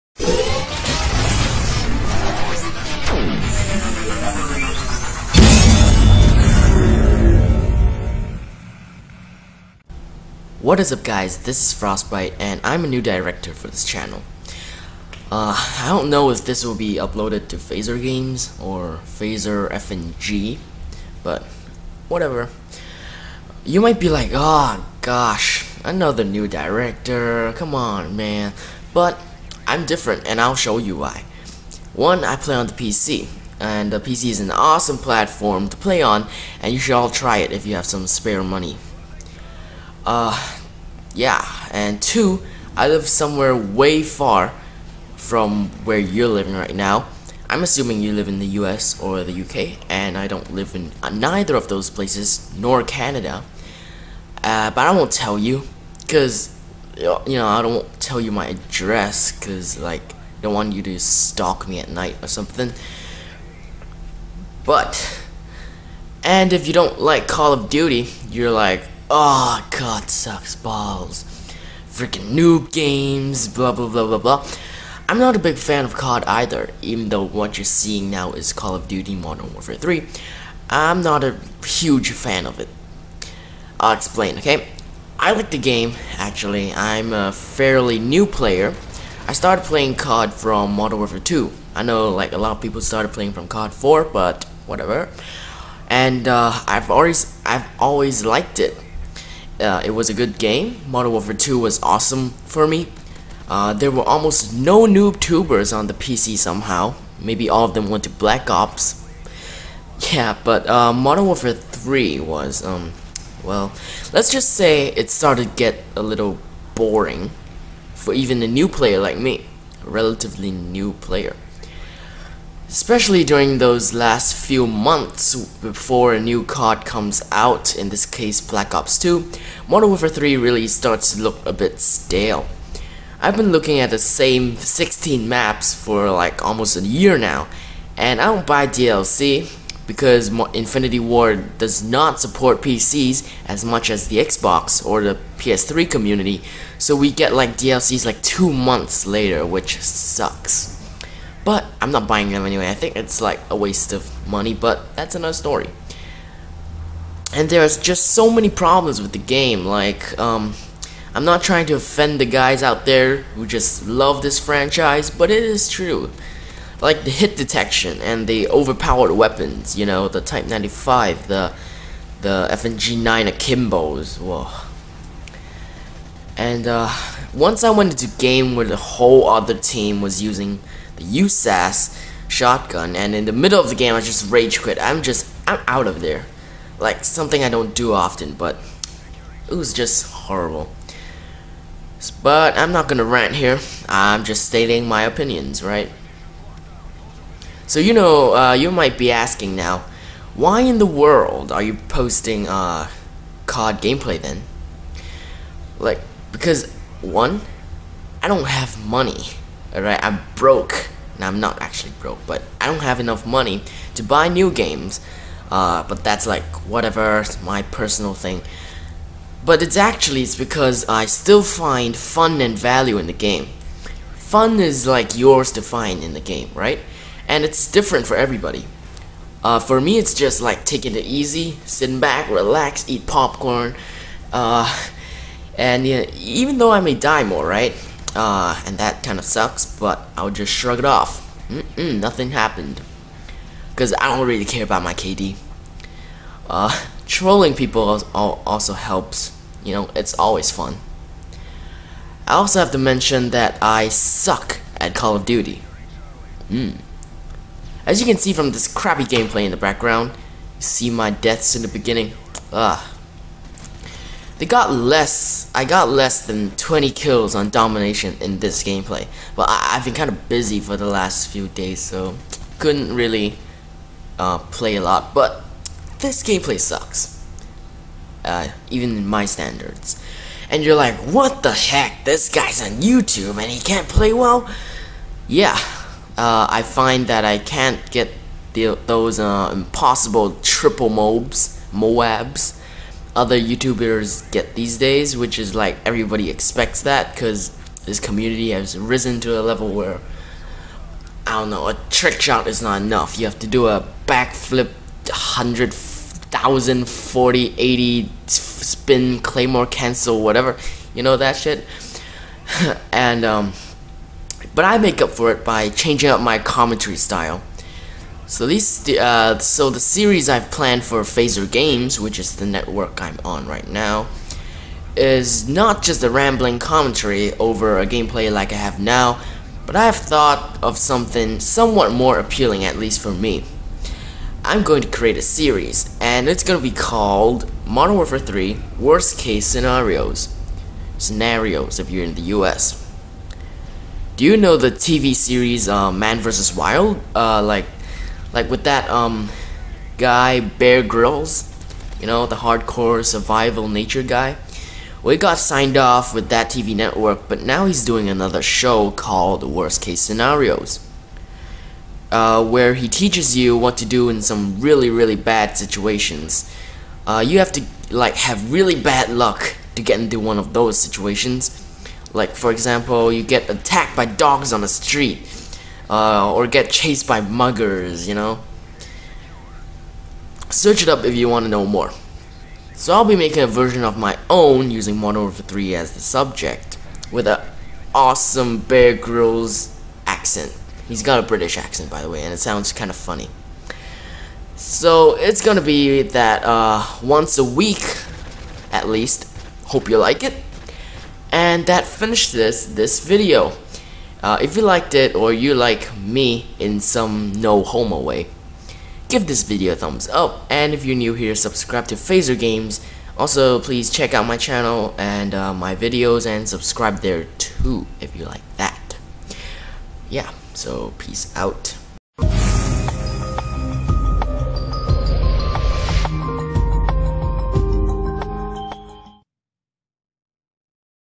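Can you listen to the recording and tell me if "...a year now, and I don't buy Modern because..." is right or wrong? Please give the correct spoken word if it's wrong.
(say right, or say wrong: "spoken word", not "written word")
wrong: "DLC", not "Modern".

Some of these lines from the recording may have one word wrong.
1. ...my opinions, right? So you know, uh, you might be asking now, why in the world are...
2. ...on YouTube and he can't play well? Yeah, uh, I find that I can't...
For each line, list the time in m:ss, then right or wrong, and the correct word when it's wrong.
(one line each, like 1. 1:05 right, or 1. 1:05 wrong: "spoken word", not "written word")
1. 3:14 right
2. 4:42 right.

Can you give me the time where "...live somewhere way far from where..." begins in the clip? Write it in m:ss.
0:42.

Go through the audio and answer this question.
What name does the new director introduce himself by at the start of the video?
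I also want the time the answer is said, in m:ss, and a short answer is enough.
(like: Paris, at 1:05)
Frostbyt3, at 0:11.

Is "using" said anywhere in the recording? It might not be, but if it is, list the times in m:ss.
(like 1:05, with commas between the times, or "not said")
3:00, 6:24.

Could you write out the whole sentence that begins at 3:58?
Uh, and that kind of sucks, but I'll just shrug it off.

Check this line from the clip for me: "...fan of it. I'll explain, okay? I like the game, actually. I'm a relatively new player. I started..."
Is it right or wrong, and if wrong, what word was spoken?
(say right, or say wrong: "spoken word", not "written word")
wrong: "fairly", not "relatively".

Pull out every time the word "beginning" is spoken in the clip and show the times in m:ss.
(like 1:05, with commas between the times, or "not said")
4:21.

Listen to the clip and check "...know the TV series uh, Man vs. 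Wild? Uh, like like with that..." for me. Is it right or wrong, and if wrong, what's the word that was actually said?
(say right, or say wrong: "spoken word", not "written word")
right.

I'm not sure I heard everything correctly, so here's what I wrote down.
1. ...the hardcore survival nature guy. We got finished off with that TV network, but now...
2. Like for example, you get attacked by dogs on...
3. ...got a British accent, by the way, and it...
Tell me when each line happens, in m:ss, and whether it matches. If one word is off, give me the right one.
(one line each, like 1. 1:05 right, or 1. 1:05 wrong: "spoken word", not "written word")
1. 5:52 wrong: "signed", not "finished"
2. 6:12 right
3. 6:31 right.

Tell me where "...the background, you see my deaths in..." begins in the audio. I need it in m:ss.
4:19.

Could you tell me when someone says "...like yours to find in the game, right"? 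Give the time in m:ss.
3:44.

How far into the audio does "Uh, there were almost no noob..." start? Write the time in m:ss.
1:43.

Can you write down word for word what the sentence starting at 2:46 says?
Like the hit detection and the overpowered weapons, you know, the Type 95, the the FMG9 Akimbos.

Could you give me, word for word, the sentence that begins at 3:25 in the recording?
Like, because one, I don't have money.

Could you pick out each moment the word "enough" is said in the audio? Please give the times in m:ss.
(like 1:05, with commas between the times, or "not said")
3:32, 5:02.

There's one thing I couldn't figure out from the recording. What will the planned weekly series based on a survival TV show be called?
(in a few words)
Modern Warfare 3 Worst Case Scenarios.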